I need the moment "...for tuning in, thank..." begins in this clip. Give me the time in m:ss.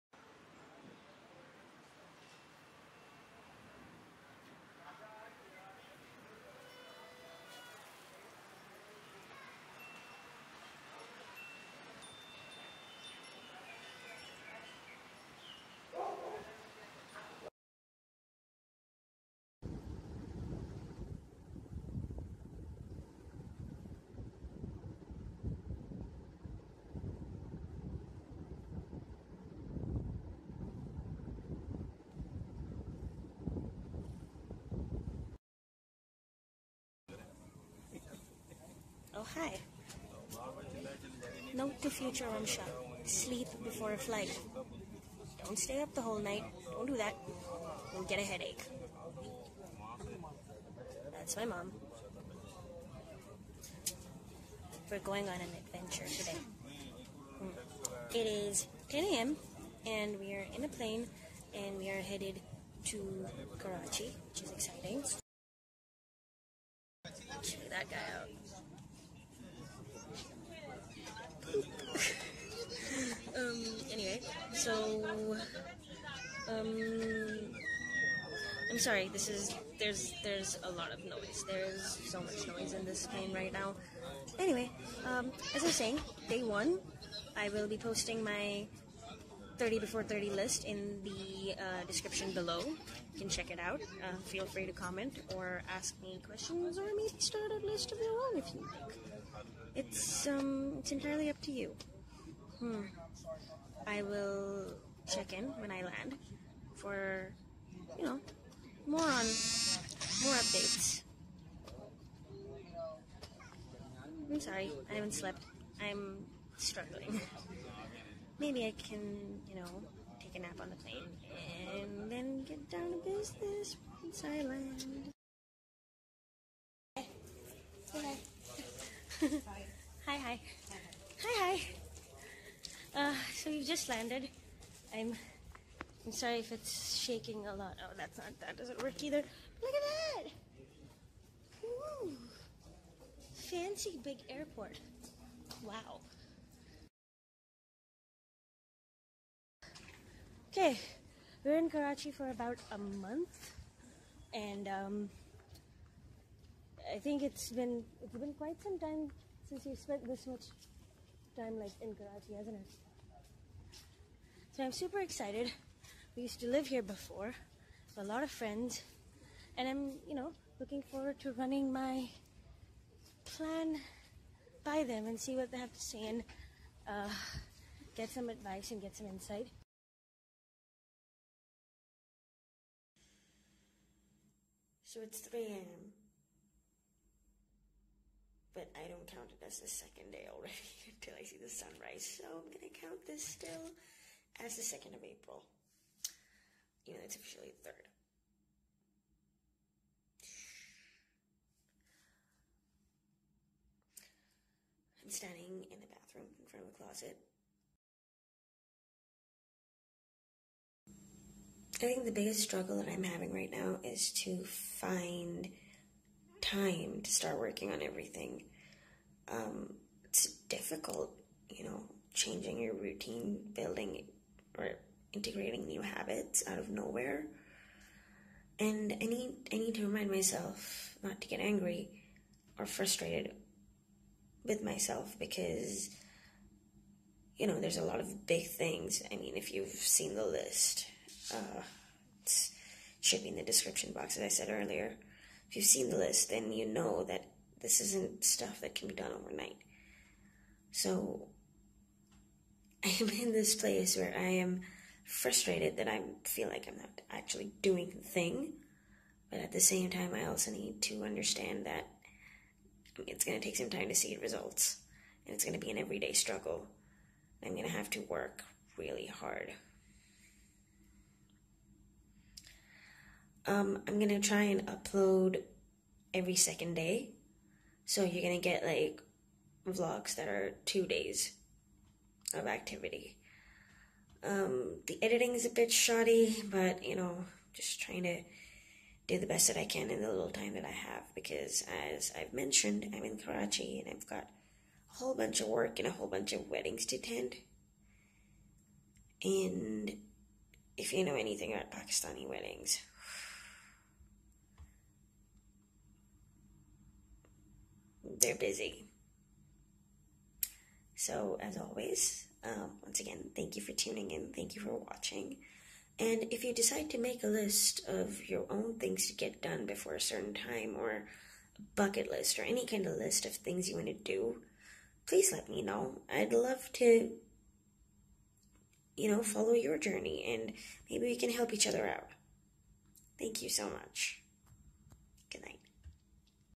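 5:13.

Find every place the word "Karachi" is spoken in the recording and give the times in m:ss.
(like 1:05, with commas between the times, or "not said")
1:03, 2:31, 2:41, 4:53.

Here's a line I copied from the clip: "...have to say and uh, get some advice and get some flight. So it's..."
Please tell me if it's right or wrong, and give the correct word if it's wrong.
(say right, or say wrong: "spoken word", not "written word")
wrong: "insight", not "flight".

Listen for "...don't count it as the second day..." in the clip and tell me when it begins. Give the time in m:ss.
3:08.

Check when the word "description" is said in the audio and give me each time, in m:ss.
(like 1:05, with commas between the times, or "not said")
1:31, 4:03.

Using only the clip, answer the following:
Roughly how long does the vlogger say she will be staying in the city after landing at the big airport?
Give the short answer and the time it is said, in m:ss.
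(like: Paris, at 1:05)
about a month, at 2:32.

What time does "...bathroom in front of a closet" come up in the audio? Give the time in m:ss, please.
3:25.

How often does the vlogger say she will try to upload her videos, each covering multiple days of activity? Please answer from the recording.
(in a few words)
every second day.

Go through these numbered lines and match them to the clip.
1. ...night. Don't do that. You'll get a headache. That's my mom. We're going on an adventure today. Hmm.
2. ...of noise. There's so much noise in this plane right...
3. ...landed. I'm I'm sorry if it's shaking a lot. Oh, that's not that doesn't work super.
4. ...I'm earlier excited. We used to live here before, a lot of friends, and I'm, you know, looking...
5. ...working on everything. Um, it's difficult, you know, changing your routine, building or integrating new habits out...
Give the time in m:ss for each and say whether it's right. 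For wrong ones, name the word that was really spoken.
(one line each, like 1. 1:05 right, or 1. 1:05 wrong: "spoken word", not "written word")
1. 0:46 right
2. 1:20 right
3. 2:13 wrong: "either", not "super"
4. 2:44 wrong: "super", not "earlier"
5. 3:37 right.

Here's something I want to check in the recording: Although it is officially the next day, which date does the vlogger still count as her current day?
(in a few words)
2nd of April.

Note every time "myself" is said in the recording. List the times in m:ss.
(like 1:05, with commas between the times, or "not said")
3:50, 3:54.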